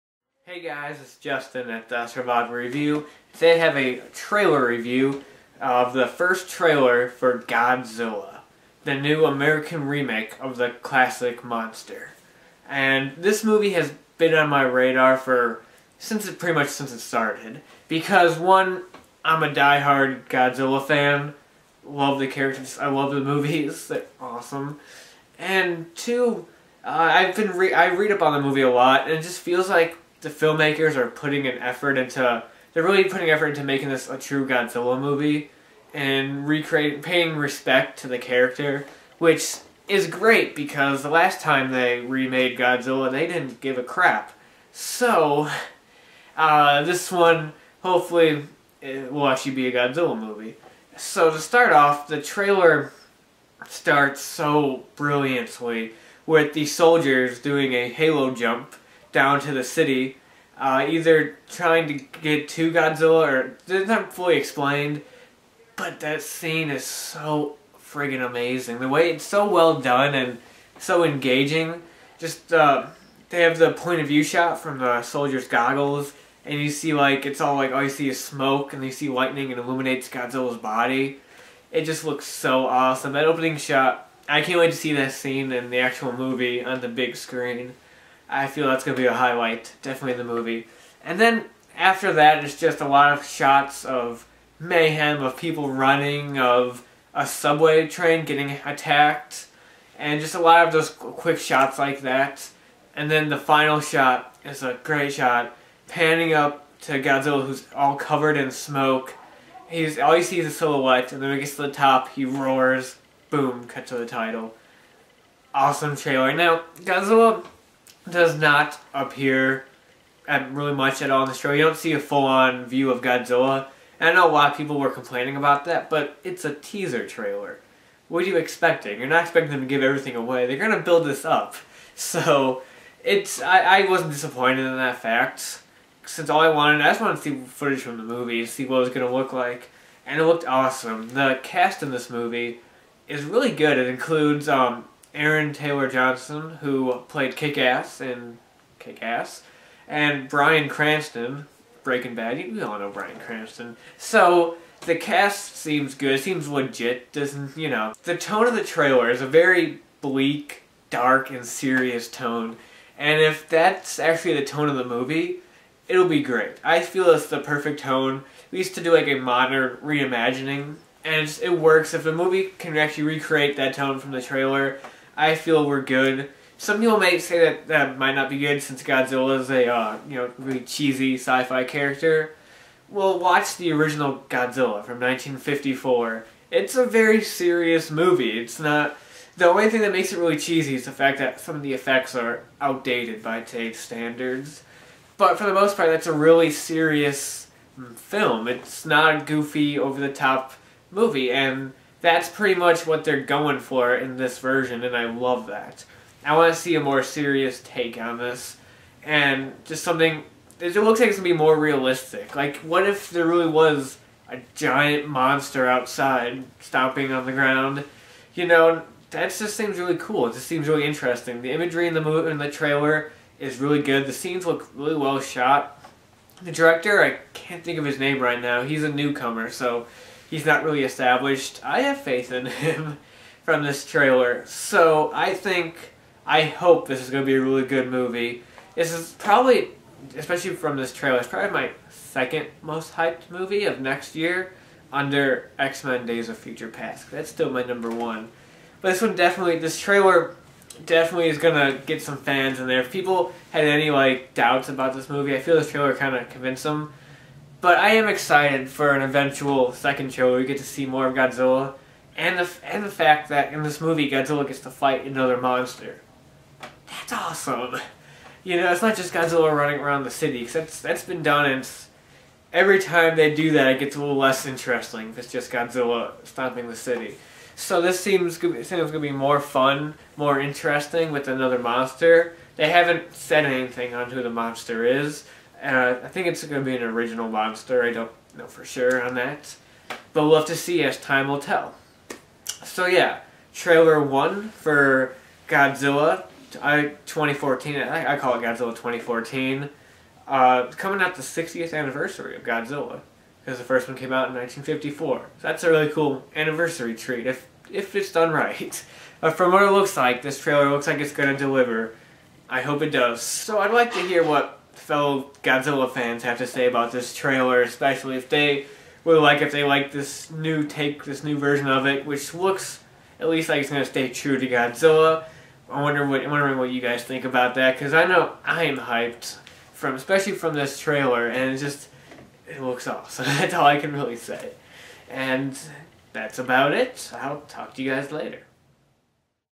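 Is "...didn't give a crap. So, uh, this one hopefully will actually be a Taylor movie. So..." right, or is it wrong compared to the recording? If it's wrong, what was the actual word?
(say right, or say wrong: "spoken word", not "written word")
wrong: "Godzilla", not "Taylor".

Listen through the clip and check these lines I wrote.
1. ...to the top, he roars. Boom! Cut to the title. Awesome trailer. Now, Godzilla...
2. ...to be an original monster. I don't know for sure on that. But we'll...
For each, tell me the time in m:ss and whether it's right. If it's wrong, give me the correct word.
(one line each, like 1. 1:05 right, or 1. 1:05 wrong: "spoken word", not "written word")
1. 1:51 right
2. 4:46 right.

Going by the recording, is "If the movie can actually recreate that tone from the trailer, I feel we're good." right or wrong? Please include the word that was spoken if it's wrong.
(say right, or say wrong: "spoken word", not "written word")
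right.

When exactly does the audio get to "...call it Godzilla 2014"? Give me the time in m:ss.
4:58.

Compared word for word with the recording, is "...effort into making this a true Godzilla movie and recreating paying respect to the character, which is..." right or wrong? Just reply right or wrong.
right.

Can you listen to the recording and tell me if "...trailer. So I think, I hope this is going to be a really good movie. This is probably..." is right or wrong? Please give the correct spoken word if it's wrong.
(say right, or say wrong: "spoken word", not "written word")
right.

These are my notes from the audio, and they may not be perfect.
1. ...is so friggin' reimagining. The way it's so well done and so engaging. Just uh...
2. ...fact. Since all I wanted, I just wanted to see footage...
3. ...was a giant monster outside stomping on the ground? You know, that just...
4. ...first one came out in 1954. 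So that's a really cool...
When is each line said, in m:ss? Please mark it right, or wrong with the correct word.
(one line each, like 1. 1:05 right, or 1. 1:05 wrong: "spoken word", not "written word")
1. 1:06 wrong: "amazing", not "reimagining"
2. 2:15 right
3. 3:33 right
4. 5:03 right.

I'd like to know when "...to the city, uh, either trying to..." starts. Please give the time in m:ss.
0:59.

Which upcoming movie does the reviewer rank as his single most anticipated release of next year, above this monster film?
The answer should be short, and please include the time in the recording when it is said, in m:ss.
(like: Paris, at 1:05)
X-Men Days of Future Past, at 4:05.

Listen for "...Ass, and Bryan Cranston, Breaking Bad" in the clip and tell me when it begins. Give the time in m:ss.
2:29.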